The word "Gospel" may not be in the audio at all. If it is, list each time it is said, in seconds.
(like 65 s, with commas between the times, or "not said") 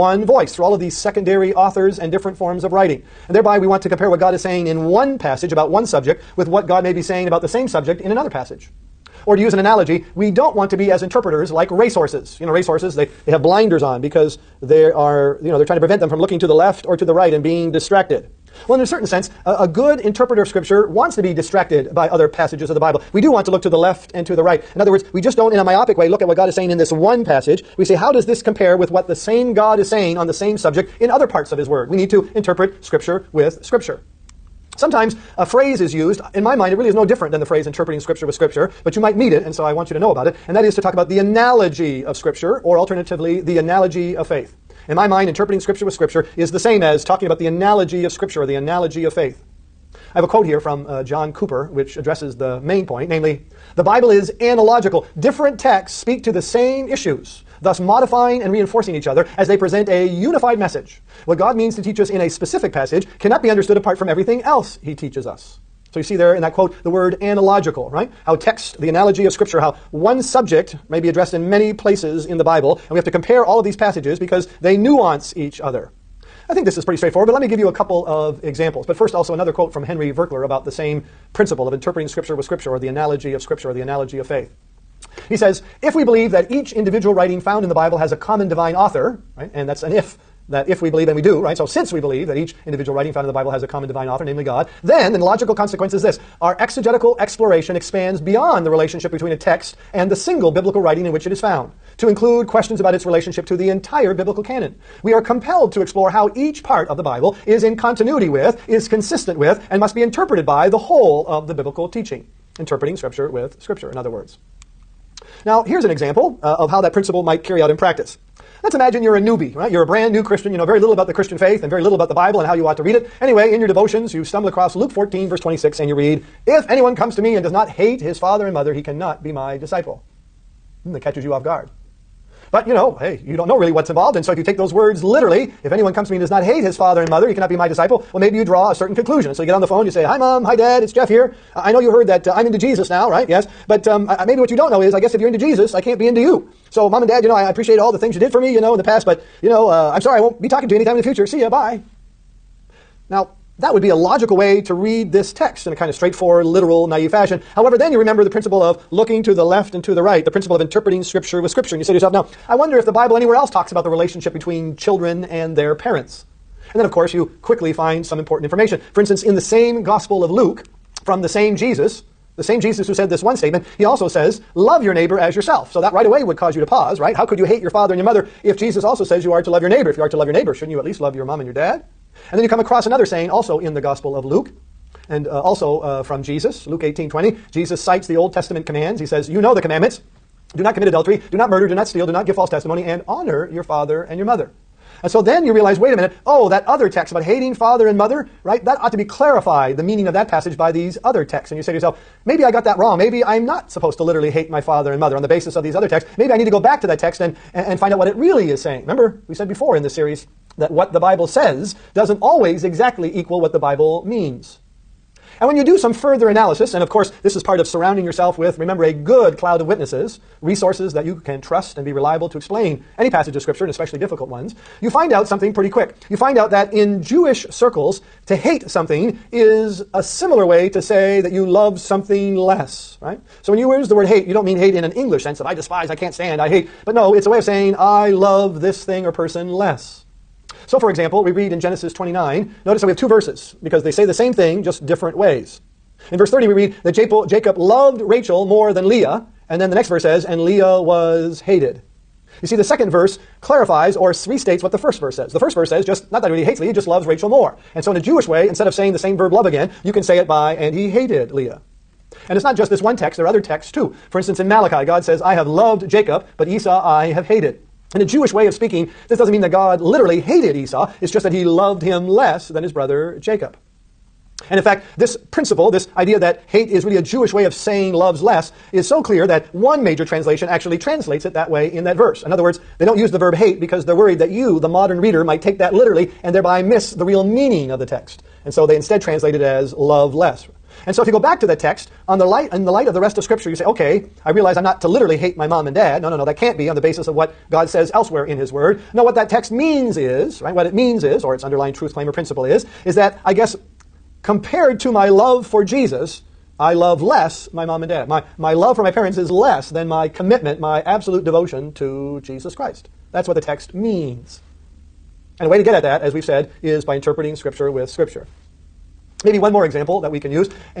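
169 s, 183 s.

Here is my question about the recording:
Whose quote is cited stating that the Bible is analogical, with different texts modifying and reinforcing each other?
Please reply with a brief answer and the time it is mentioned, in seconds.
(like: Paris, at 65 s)
John Cooper, at 51 s.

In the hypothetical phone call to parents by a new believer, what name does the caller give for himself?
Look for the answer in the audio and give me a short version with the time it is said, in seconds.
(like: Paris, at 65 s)
Jeff, at 140 s.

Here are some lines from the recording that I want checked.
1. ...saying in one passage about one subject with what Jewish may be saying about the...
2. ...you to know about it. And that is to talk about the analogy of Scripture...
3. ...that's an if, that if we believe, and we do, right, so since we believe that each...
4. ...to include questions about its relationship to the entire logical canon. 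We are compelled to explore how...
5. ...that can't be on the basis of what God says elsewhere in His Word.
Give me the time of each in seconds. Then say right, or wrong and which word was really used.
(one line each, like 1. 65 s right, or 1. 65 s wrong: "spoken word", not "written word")
1. 4 s wrong: "God", not "Jewish"
2. 39 s right
3. 89 s right
4. 101 s wrong: "biblical", not "logical"
5. 296 s right.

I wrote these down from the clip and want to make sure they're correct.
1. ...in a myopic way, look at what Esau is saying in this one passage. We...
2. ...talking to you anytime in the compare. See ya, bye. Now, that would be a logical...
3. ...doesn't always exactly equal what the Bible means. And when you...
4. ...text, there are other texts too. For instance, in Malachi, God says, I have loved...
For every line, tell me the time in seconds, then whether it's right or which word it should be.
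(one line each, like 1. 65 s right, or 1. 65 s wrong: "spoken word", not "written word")
1. 25 s wrong: "God", not "Esau"
2. 150 s wrong: "future", not "compare"
3. 211 s right
4. 262 s right.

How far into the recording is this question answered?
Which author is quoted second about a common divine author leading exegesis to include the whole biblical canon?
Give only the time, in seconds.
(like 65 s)
79 s.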